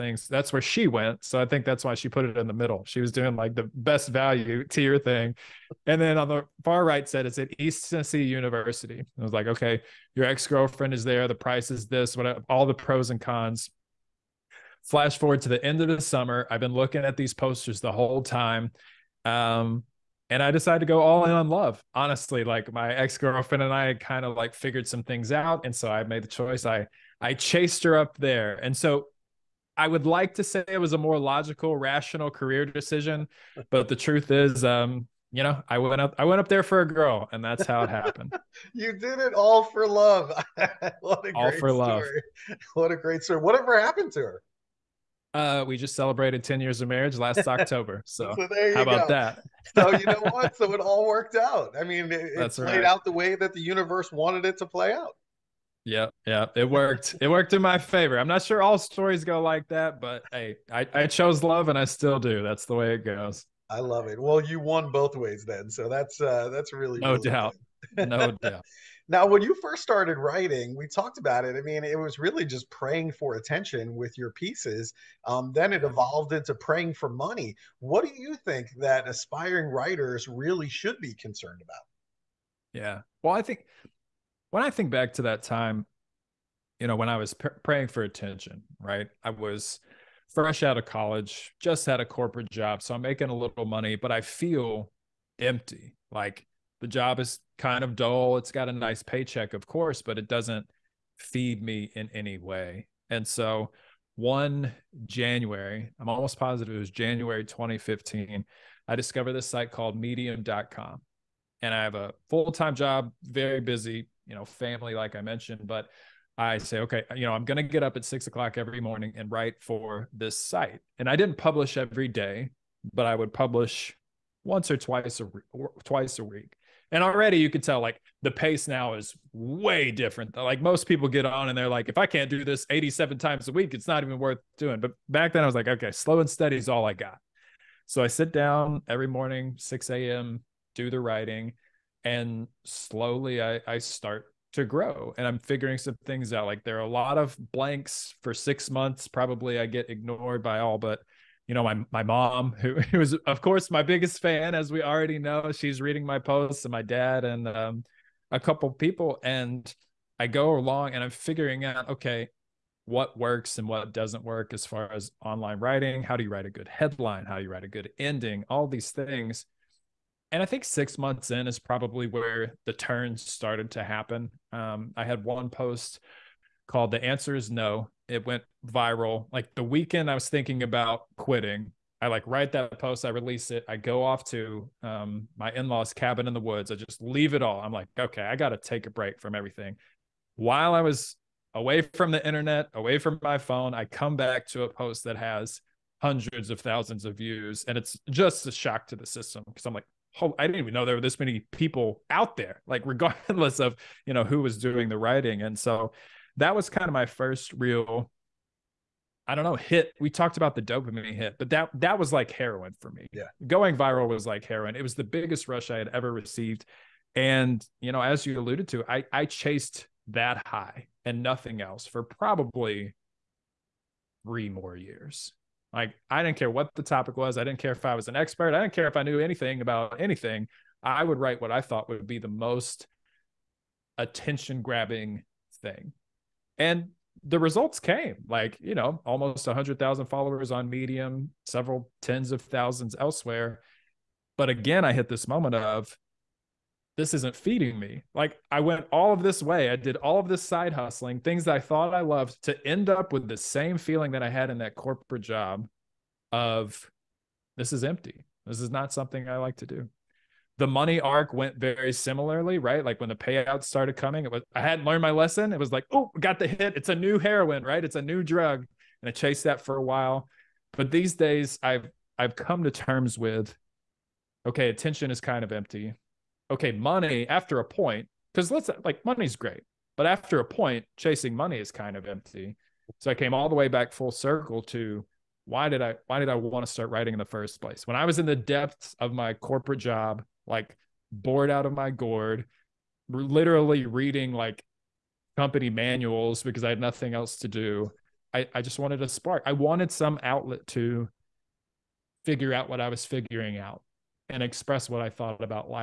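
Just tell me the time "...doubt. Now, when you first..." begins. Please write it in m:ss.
1:08.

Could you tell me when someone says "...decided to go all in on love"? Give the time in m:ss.
0:20.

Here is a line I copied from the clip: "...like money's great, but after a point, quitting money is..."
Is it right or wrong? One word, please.
wrong.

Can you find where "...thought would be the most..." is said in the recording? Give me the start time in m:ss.
3:51.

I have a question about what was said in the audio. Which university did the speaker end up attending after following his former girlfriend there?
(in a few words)
East Tennessee University.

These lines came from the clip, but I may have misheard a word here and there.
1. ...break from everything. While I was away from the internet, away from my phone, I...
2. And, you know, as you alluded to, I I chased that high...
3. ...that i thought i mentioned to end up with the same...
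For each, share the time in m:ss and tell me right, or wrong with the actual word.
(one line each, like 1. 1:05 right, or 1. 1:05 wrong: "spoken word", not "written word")
1. 3:08 right
2. 3:37 right
3. 4:11 wrong: "loved", not "mentioned".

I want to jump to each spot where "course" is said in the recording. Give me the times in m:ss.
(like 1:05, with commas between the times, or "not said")
1:39, 2:33.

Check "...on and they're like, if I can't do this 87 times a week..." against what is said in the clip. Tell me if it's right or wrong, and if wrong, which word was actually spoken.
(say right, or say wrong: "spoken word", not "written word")
right.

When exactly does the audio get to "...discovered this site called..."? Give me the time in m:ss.
1:48.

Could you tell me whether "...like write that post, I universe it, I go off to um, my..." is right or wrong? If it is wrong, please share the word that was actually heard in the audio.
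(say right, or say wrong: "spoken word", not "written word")
wrong: "release", not "universe".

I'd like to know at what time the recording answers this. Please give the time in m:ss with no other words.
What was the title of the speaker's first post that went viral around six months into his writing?
2:56.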